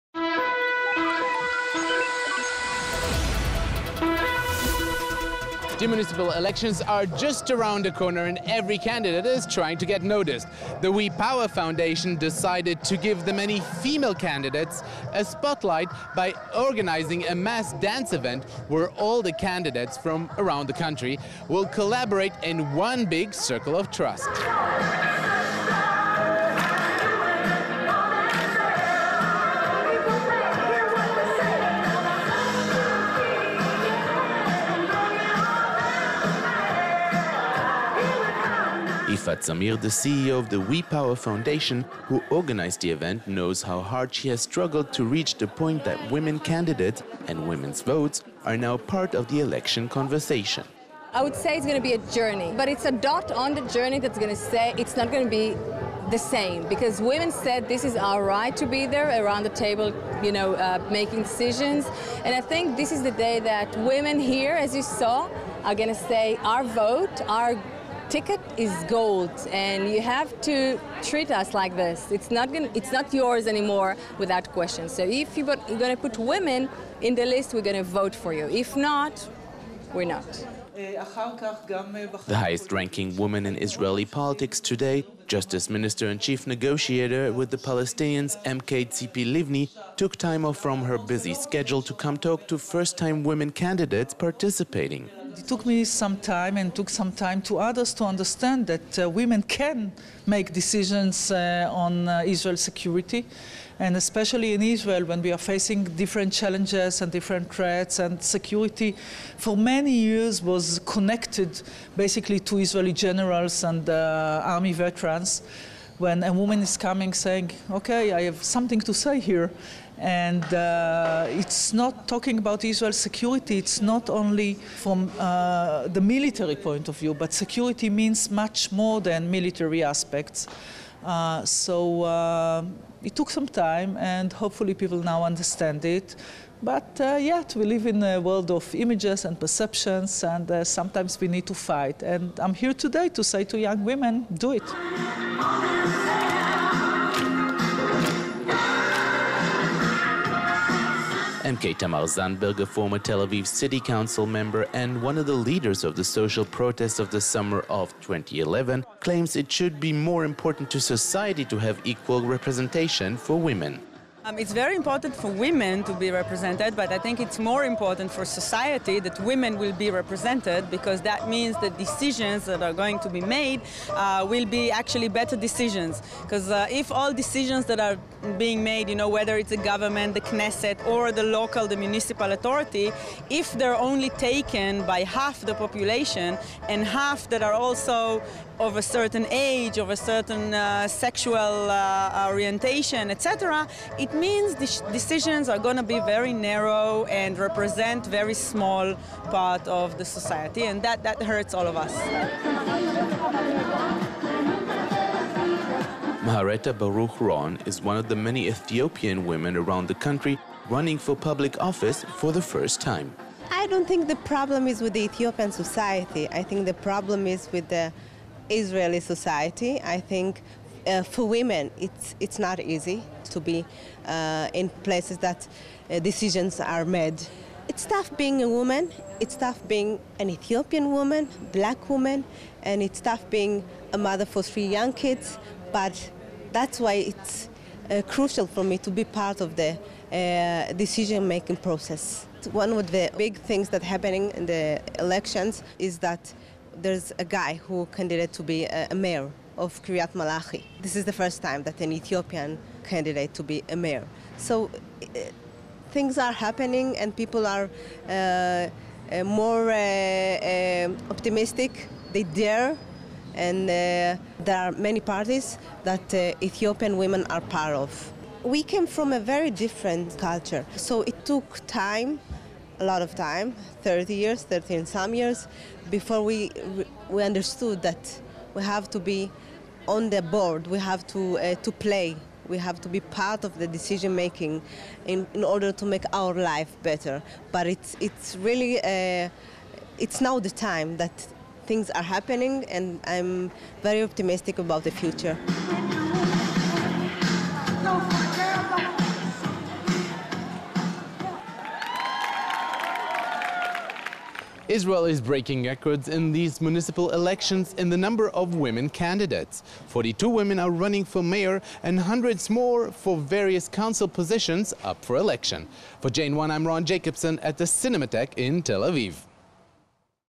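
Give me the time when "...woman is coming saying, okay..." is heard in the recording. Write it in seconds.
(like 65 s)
116 s.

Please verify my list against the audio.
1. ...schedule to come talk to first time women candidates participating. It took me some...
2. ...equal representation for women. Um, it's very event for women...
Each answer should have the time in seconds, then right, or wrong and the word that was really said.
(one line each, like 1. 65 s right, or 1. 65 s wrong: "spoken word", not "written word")
1. 91 s right
2. 161 s wrong: "important", not "event".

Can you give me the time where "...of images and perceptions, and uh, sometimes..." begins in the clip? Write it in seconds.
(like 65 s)
138 s.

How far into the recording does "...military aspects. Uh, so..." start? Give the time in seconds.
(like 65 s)
129 s.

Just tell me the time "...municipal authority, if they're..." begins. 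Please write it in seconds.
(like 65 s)
181 s.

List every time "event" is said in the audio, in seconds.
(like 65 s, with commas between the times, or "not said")
18 s, 42 s.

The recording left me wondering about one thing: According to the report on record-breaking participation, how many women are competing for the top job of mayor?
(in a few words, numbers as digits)
42.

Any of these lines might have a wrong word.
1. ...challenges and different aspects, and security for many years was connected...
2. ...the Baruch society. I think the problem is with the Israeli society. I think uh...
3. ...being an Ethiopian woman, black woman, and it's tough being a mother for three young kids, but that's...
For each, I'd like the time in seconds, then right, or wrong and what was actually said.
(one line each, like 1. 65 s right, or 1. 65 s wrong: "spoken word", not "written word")
1. 106 s wrong: "threats", not "aspects"
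2. 214 s wrong: "Ethiopian", not "Baruch"
3. 229 s right.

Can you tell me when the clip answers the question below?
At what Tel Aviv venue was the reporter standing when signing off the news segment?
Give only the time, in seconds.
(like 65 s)
317 s.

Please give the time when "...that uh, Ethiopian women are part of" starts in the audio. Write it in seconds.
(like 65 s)
265 s.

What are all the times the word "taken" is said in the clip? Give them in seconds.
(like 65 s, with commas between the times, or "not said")
184 s.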